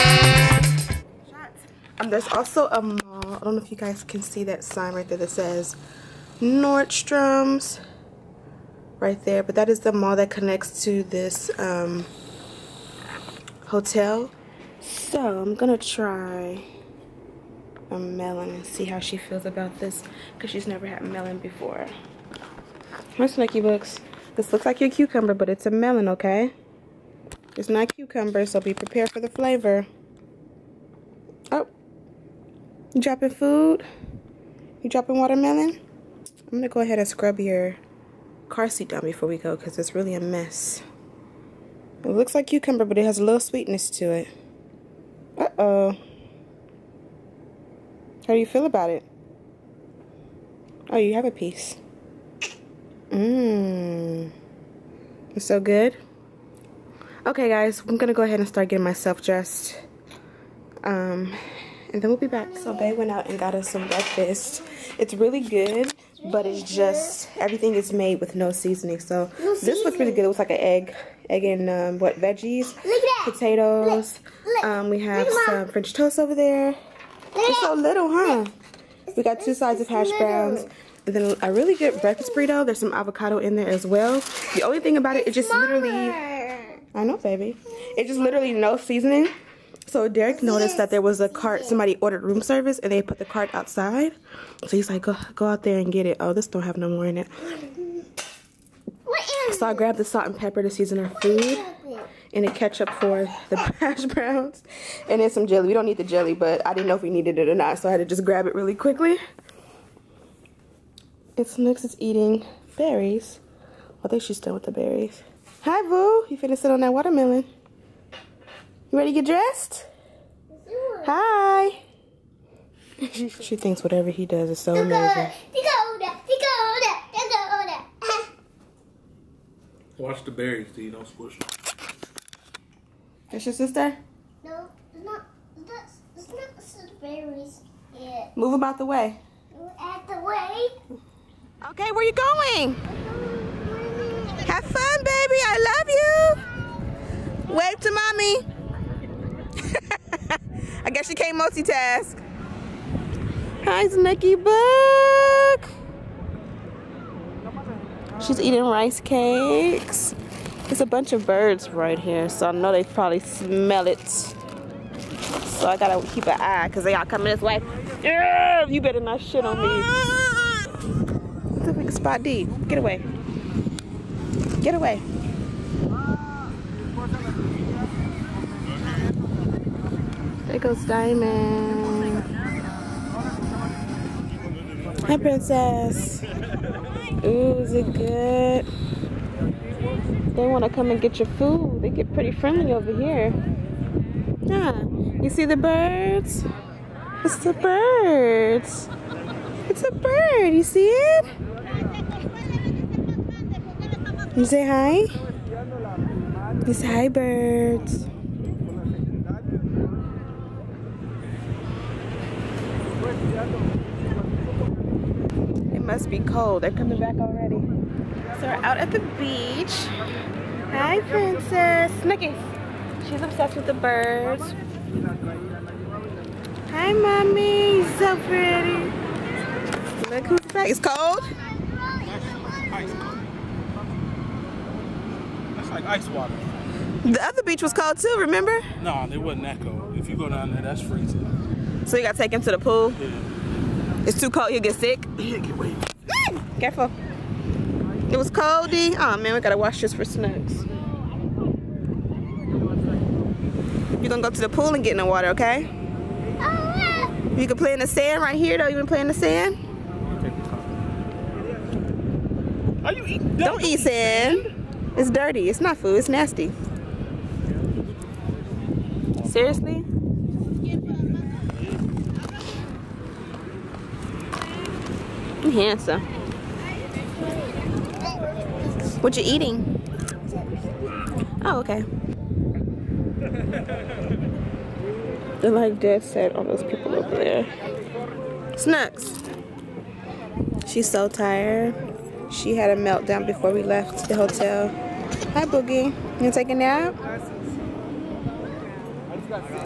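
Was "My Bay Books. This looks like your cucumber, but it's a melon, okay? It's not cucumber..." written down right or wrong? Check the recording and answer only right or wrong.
wrong.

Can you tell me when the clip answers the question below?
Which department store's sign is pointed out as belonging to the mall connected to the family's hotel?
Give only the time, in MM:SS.
00:06.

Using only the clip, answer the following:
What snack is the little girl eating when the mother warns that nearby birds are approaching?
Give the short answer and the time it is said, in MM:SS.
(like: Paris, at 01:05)
Rice cakes, at 02:38.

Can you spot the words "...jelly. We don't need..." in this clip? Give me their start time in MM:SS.
01:45.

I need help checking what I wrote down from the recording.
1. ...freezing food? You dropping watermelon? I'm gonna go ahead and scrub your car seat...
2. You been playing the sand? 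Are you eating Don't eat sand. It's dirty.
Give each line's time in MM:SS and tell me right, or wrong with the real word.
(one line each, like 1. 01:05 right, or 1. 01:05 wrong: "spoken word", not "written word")
1. 00:33 wrong: "dropping", not "freezing"
2. 04:18 right.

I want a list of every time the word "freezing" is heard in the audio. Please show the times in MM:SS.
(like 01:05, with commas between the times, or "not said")
04:00.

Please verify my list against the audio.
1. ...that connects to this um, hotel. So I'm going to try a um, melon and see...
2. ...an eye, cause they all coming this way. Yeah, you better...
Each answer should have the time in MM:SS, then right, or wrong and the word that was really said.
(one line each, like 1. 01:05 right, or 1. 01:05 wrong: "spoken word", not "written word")
1. 00:10 right
2. 02:46 right.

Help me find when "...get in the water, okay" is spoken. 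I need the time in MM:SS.
04:14.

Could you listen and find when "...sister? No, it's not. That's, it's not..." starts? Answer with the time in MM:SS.
02:13.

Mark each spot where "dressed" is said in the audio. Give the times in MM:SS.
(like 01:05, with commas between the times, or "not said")
00:59, 01:59.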